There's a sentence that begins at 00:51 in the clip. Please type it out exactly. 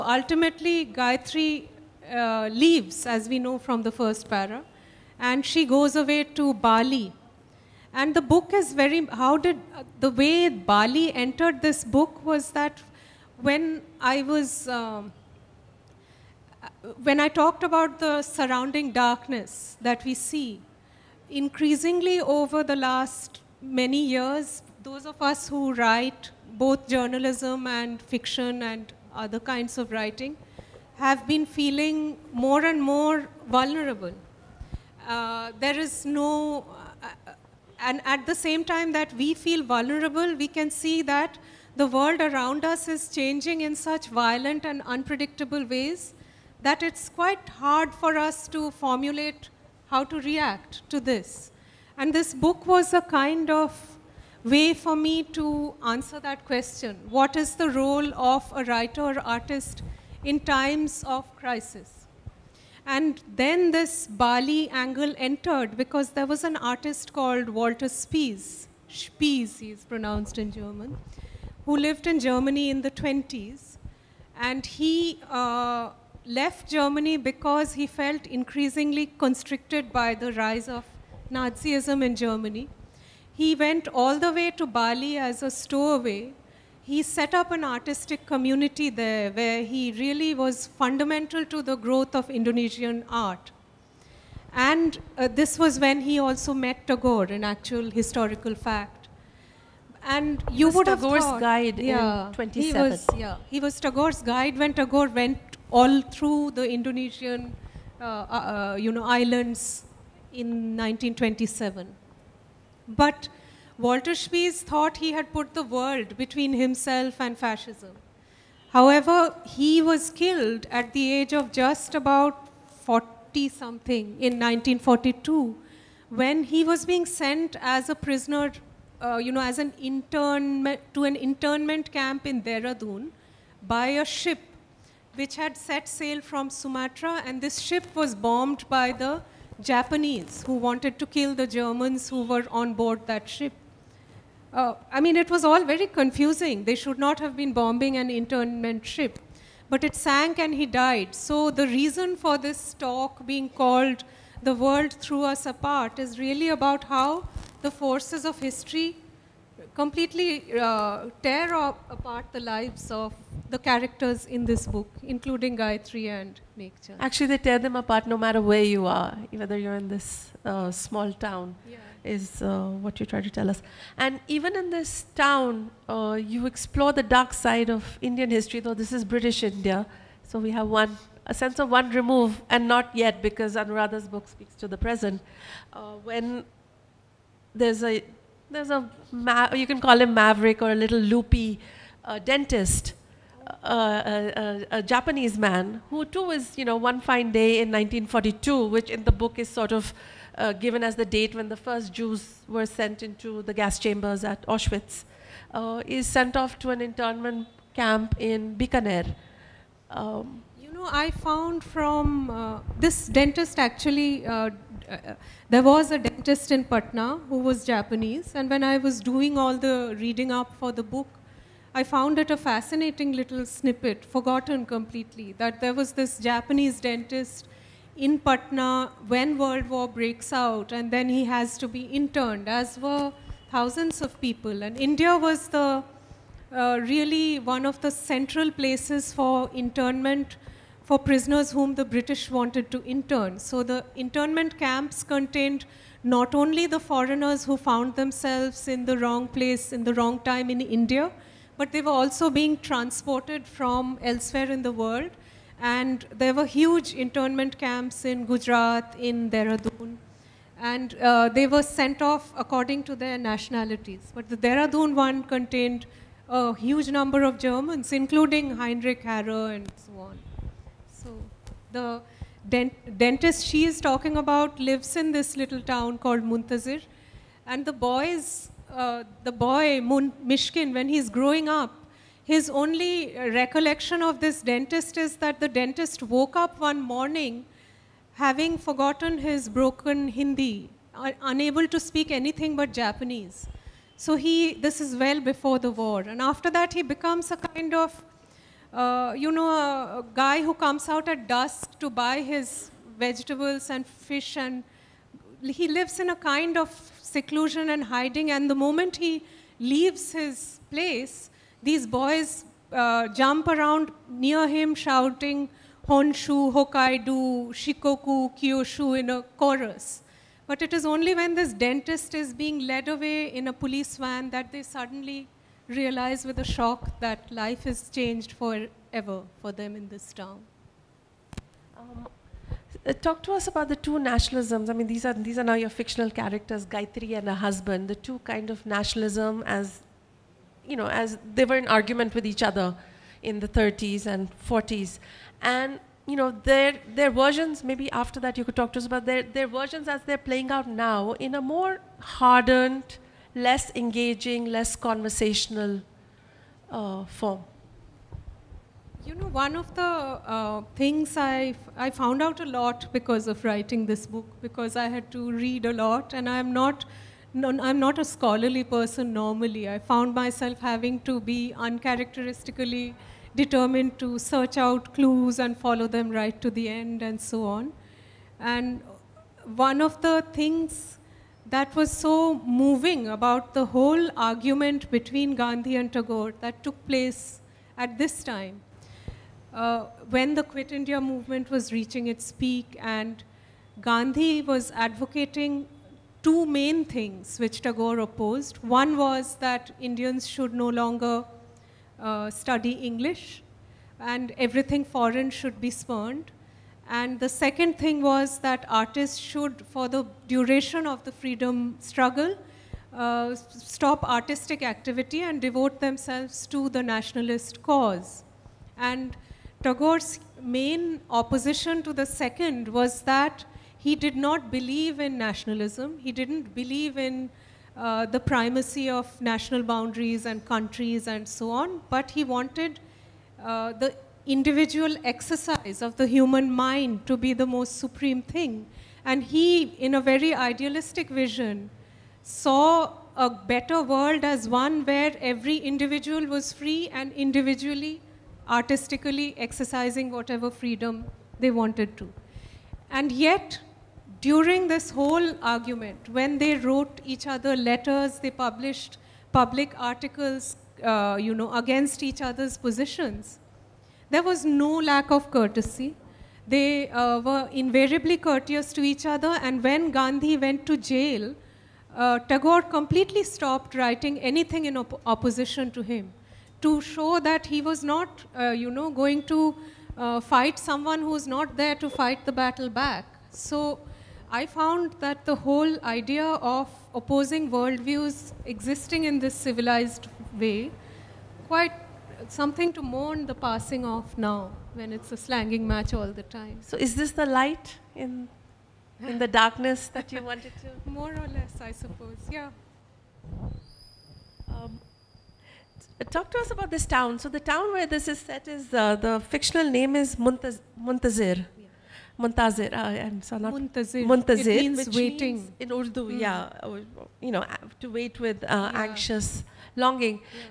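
And this book was a kind of way for me to answer that question.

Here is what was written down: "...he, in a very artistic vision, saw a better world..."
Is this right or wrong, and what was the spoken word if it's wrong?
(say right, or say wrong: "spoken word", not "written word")
wrong: "idealistic", not "artistic".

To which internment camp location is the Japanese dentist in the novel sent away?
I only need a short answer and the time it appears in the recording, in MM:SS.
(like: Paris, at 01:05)
Bikaner, at 03:28.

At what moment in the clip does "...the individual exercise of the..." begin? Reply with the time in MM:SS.
07:13.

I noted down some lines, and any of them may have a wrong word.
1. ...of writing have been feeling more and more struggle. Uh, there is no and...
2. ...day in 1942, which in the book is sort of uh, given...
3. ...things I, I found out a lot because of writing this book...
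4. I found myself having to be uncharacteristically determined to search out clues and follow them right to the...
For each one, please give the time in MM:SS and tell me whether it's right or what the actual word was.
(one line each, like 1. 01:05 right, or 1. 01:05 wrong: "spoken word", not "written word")
1. 00:29 wrong: "vulnerable", not "struggle"
2. 03:17 right
3. 06:00 right
4. 06:09 right.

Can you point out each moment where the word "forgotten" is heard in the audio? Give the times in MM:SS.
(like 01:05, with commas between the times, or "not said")
03:44, 04:48.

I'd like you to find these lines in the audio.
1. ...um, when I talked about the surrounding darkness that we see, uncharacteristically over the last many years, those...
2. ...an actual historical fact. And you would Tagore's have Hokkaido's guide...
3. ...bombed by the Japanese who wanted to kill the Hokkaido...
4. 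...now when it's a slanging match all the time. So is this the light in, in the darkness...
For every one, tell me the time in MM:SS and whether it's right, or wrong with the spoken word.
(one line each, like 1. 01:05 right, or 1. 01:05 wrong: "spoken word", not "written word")
1. 00:14 wrong: "increasingly", not "uncharacteristically"
2. 01:37 wrong: "Tagore", not "Hokkaido"
3. 02:18 wrong: "Germans", not "Hokkaido"
4. 08:14 right.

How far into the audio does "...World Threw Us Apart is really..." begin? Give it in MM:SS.
02:34.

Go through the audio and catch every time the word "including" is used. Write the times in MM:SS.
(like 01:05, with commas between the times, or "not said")
02:45, 04:27.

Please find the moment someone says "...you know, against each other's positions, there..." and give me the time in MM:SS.
07:41.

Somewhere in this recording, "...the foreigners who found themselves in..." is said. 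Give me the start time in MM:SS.
04:06.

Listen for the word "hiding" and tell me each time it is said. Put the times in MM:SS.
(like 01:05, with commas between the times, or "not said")
05:07.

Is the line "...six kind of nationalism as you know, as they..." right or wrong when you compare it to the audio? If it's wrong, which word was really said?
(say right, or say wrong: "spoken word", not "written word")
wrong: "two", not "six".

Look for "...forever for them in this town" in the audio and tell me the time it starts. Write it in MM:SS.
05:28.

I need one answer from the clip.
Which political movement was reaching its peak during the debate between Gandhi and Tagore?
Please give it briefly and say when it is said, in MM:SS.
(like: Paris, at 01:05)
Quit India movement, at 06:30.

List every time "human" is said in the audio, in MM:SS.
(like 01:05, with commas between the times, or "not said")
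07:16.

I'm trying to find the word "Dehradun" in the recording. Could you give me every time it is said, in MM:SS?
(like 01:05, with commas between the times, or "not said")
02:12, 04:19, 04:24.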